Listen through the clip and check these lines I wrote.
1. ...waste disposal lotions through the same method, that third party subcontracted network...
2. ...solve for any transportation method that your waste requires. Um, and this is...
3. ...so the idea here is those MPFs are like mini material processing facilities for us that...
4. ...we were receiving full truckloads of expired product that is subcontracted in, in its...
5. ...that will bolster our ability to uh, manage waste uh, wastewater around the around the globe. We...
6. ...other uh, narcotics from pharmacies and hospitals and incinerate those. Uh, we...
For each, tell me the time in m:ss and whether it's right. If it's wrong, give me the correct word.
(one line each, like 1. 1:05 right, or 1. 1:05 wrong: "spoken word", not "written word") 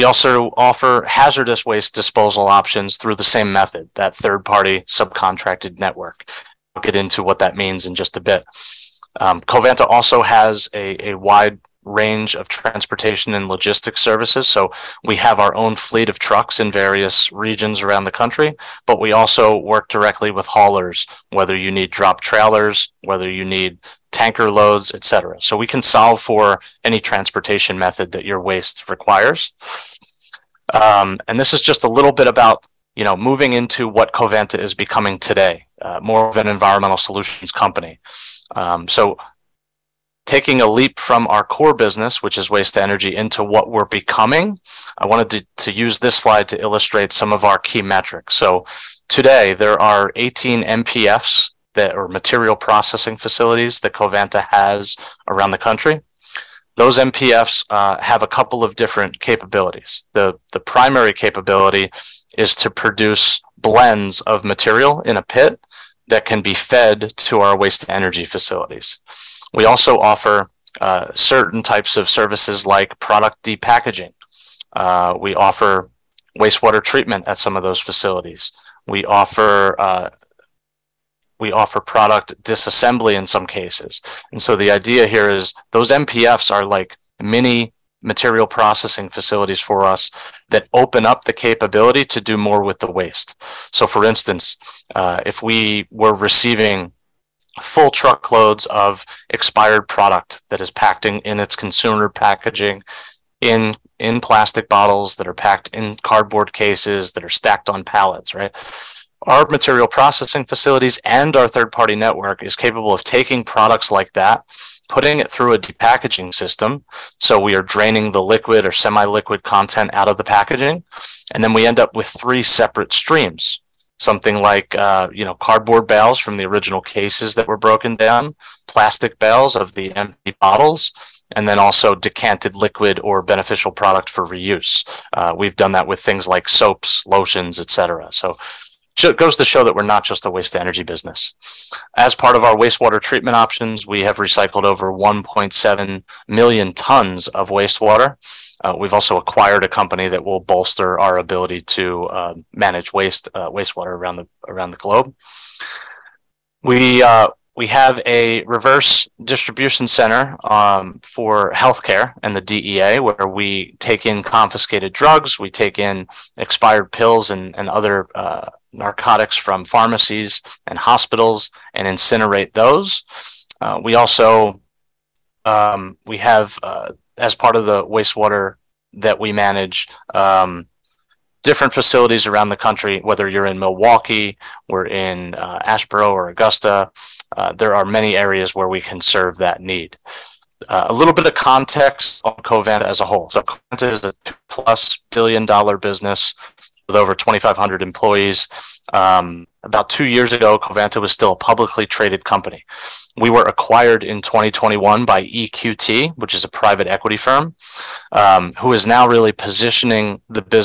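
1. 0:01 wrong: "options", not "lotions"
2. 0:25 right
3. 1:24 right
4. 1:35 wrong: "packed", not "subcontracted"
5. 2:30 right
6. 2:47 right.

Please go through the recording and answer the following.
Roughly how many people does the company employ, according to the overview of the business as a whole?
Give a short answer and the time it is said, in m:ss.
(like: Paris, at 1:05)
over 2,500, at 3:16.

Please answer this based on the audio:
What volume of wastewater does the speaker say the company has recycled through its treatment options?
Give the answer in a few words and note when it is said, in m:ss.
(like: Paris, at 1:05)
1.7 million tons, at 2:24.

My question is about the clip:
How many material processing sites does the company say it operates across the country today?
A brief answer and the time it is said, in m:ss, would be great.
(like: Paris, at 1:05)
18, at 0:50.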